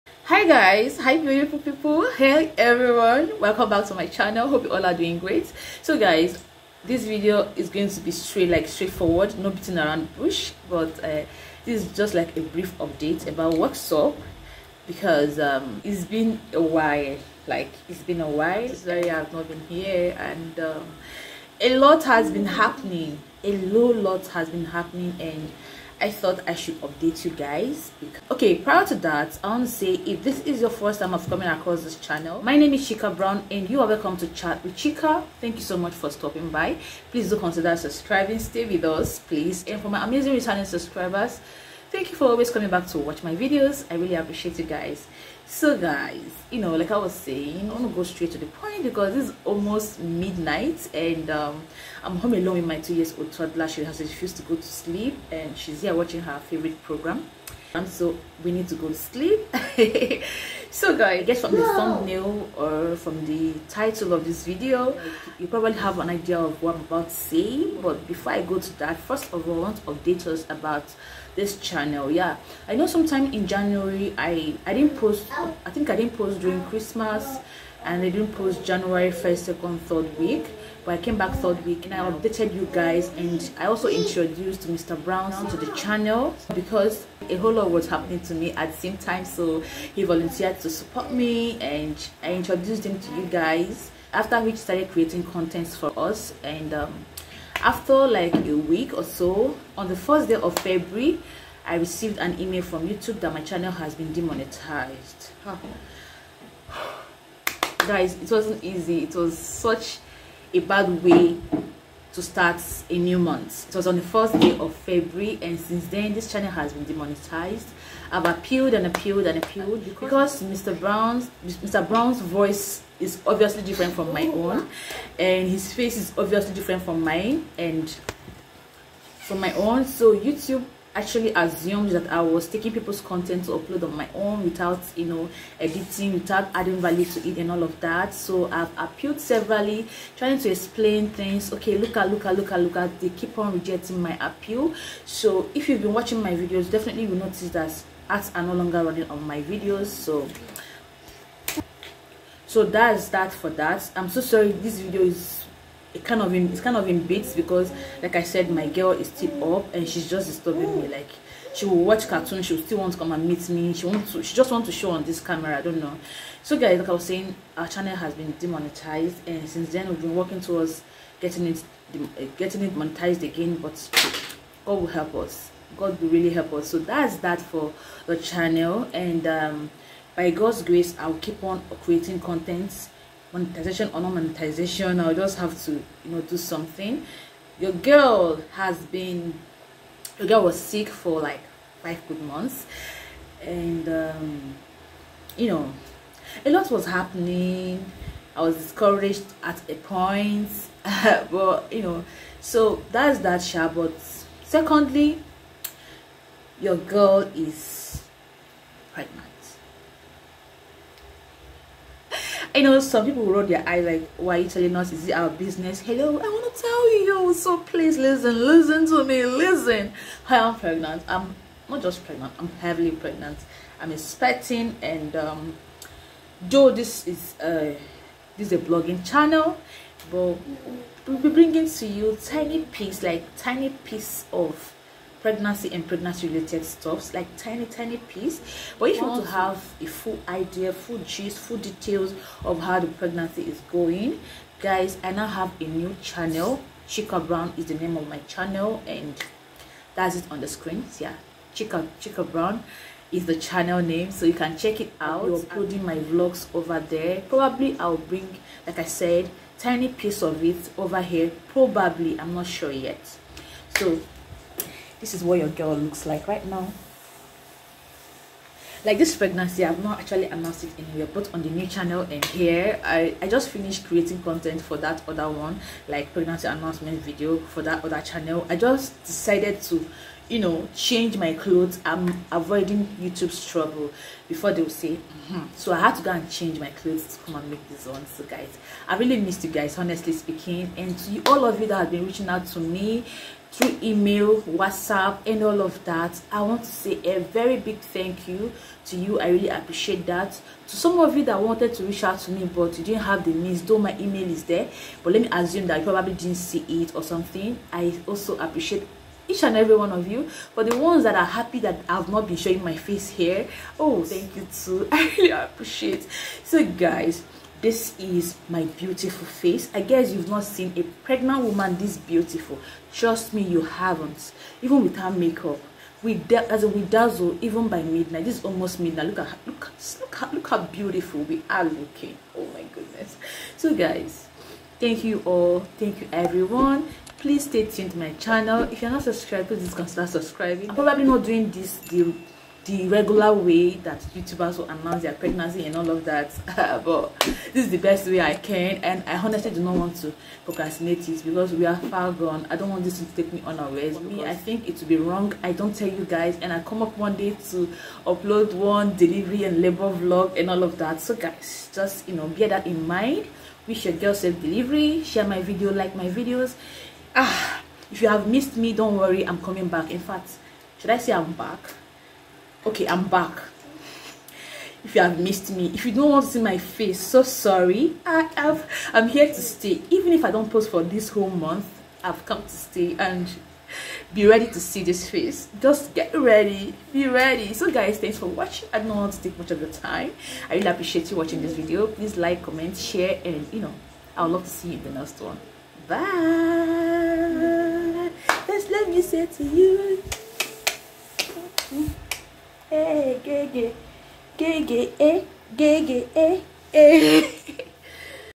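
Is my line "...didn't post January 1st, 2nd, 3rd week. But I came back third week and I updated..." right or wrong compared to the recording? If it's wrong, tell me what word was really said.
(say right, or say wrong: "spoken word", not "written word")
right.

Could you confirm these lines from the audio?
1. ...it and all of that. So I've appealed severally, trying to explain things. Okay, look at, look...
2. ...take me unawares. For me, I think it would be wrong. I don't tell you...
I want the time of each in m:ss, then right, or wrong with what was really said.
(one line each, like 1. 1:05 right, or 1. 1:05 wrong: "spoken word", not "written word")
1. 2:17 right
2. 5:53 right.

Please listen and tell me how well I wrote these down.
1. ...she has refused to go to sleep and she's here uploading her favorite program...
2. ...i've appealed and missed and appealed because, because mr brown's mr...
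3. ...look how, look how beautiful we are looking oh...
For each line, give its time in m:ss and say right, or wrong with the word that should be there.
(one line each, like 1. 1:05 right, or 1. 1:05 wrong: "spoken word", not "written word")
1. 0:53 wrong: "watching", not "uploading"
2. 1:58 wrong: "appealed", not "missed"
3. 5:29 right.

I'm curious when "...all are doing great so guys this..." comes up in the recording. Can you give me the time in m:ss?
0:04.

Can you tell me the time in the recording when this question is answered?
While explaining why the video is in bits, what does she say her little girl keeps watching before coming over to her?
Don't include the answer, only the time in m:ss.
2:42.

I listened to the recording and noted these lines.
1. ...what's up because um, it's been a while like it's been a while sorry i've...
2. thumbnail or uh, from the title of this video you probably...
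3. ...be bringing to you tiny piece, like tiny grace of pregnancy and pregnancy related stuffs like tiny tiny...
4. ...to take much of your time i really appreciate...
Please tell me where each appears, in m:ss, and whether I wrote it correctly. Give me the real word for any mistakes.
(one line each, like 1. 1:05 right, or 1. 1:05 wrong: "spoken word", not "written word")
1. 0:13 right
2. 1:01 right
3. 3:51 wrong: "piece", not "grace"
4. 6:29 right.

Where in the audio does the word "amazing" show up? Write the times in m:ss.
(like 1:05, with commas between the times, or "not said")
0:40.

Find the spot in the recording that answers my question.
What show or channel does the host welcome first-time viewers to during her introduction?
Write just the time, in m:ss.
0:34.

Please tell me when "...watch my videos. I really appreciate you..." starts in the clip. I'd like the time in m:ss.
0:42.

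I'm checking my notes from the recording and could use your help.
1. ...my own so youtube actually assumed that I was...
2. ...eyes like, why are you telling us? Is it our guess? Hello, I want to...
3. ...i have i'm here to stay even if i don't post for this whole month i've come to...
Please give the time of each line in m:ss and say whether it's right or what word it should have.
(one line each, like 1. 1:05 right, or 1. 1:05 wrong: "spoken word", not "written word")
1. 2:09 right
2. 3:33 wrong: "business", not "guess"
3. 6:18 right.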